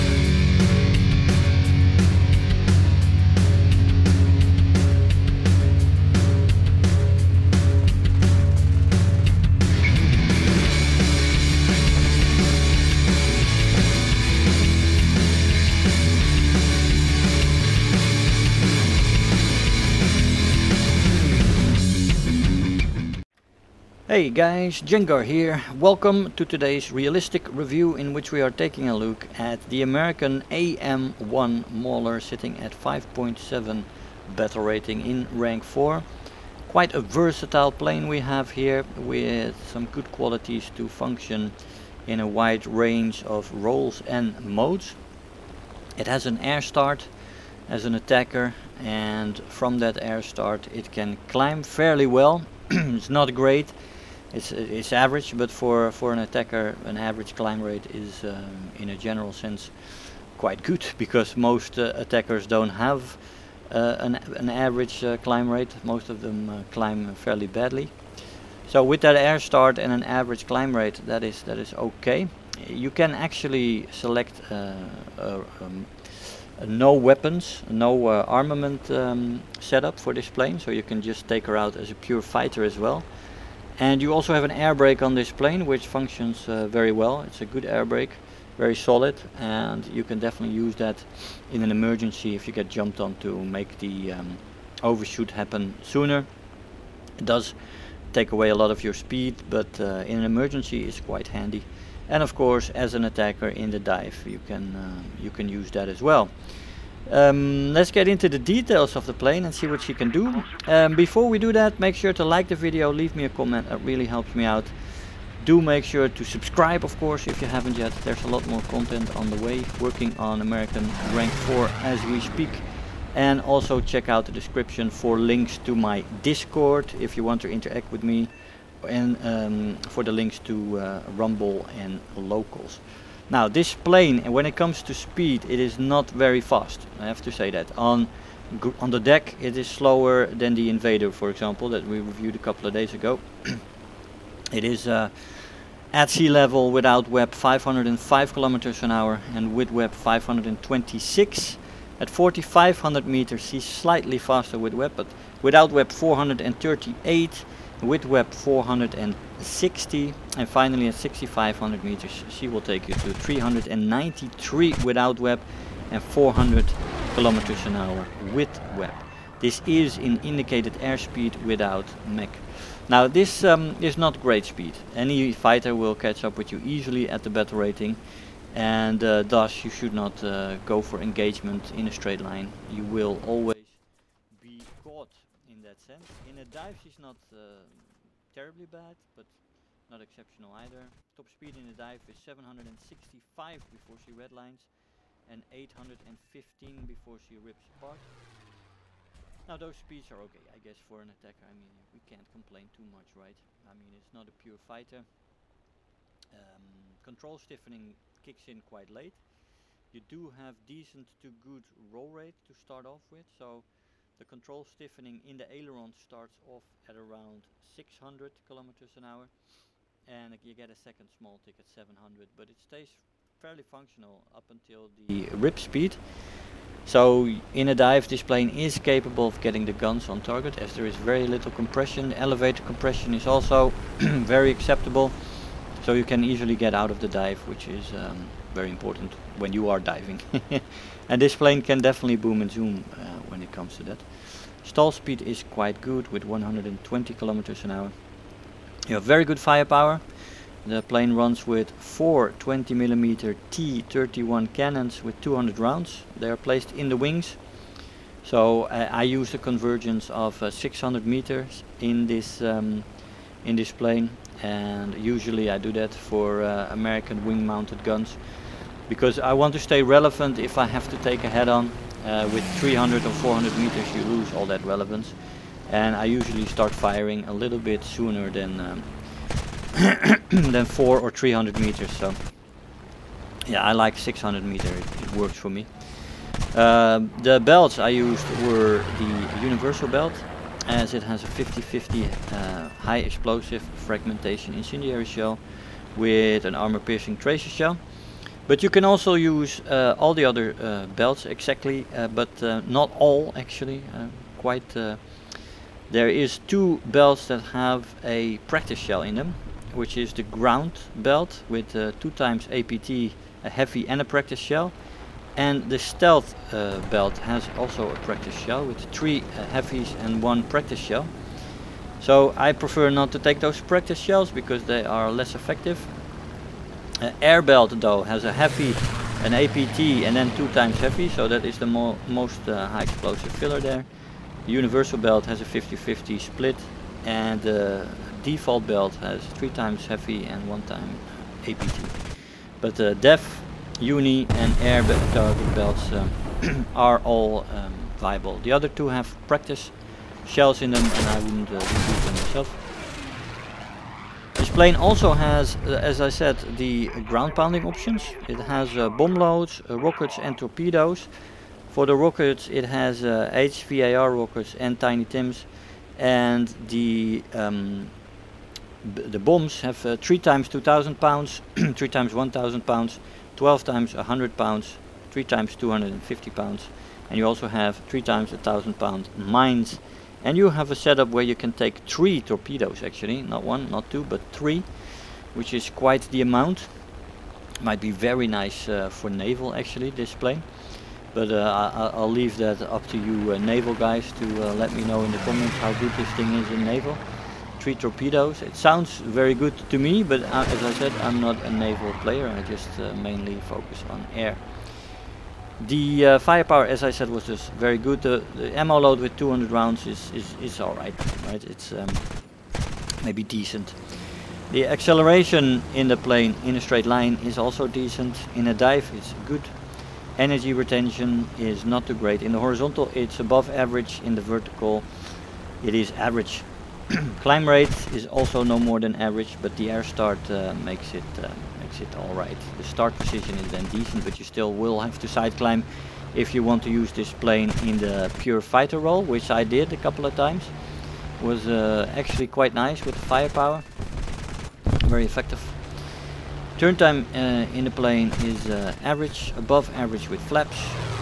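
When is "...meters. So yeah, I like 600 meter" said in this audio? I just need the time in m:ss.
4:41.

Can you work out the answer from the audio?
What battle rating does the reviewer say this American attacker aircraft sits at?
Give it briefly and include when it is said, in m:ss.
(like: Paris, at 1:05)
5.7, at 0:32.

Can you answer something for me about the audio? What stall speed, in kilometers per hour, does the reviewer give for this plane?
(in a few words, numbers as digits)
120.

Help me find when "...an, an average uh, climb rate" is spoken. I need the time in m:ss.
1:03.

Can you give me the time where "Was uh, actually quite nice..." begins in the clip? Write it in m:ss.
7:21.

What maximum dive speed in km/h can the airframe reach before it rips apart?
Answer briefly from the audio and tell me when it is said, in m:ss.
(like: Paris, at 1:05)
815, at 3:15.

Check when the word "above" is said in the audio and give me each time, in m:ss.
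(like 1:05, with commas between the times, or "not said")
7:03, 7:29.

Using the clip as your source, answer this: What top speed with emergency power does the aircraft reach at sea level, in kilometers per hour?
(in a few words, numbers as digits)
526.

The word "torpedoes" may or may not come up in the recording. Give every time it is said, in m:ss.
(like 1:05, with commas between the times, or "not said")
6:00, 6:22, 6:37.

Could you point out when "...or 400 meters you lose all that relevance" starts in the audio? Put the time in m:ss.
4:33.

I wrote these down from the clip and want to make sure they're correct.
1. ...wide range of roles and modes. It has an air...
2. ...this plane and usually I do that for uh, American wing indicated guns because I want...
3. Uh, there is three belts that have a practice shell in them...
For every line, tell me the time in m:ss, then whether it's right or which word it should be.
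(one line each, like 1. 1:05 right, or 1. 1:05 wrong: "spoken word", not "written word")
1. 0:42 right
2. 4:23 wrong: "mounted", not "indicated"
3. 5:04 wrong: "two", not "three".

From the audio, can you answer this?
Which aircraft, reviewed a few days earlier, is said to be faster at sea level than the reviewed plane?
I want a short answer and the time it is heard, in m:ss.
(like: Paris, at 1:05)
Invader, at 2:20.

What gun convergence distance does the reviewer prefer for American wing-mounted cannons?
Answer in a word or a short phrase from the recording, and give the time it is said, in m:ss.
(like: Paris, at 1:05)
600 meters, at 4:20.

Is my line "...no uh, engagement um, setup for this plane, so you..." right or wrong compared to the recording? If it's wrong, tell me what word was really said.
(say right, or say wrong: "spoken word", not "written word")
wrong: "armament", not "engagement".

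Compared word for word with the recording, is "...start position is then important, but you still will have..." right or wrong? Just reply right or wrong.
wrong.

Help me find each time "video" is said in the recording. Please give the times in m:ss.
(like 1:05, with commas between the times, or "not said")
1:52.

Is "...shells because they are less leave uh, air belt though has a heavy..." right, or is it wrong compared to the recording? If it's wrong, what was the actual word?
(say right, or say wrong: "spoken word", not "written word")
wrong: "effective", not "leave".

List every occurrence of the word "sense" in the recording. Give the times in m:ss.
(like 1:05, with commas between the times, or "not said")
0:59, 3:05.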